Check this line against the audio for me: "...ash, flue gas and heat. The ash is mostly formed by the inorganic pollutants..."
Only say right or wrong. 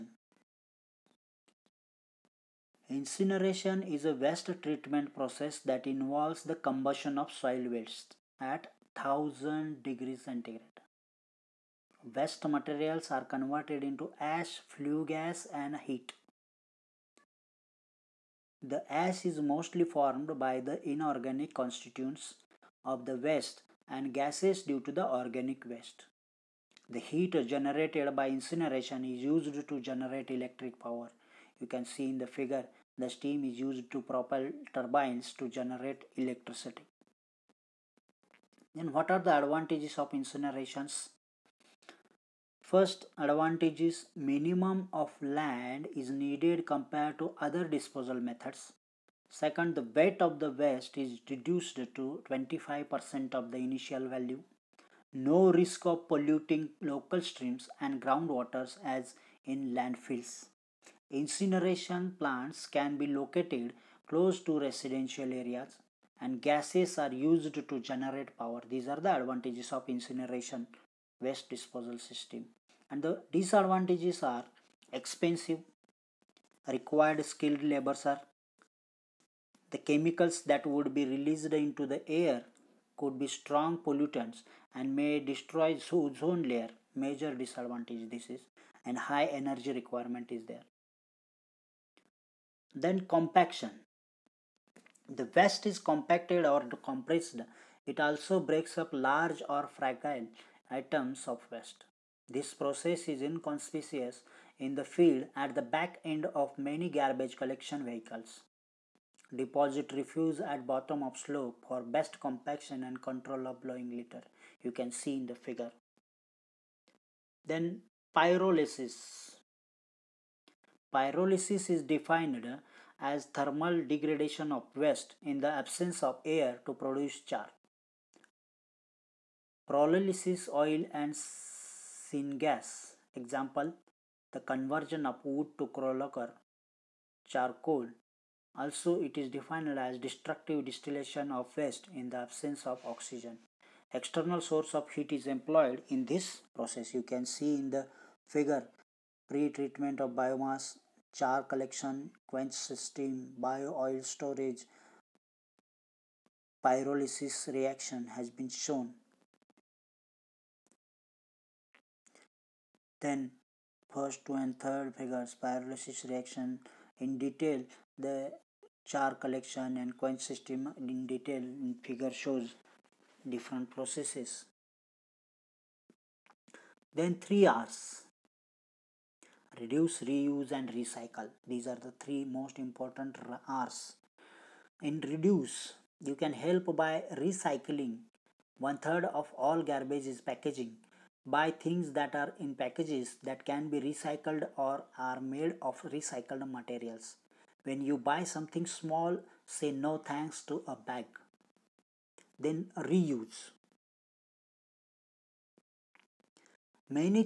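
wrong.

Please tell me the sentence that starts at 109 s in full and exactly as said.
Deposit refuse at bottom of slope for best compaction and control of blowing litter.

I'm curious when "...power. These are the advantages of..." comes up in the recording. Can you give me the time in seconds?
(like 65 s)
68 s.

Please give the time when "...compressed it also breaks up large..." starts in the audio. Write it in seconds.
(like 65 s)
96 s.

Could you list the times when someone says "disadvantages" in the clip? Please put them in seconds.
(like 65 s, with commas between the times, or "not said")
73 s, 87 s.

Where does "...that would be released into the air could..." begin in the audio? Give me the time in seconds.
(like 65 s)
80 s.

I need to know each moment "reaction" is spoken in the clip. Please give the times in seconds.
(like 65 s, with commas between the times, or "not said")
157 s, 166 s.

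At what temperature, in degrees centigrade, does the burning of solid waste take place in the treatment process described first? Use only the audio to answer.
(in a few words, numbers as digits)
1000 degrees centigrade.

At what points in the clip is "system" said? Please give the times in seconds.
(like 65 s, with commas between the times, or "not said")
71 s, 152 s, 170 s.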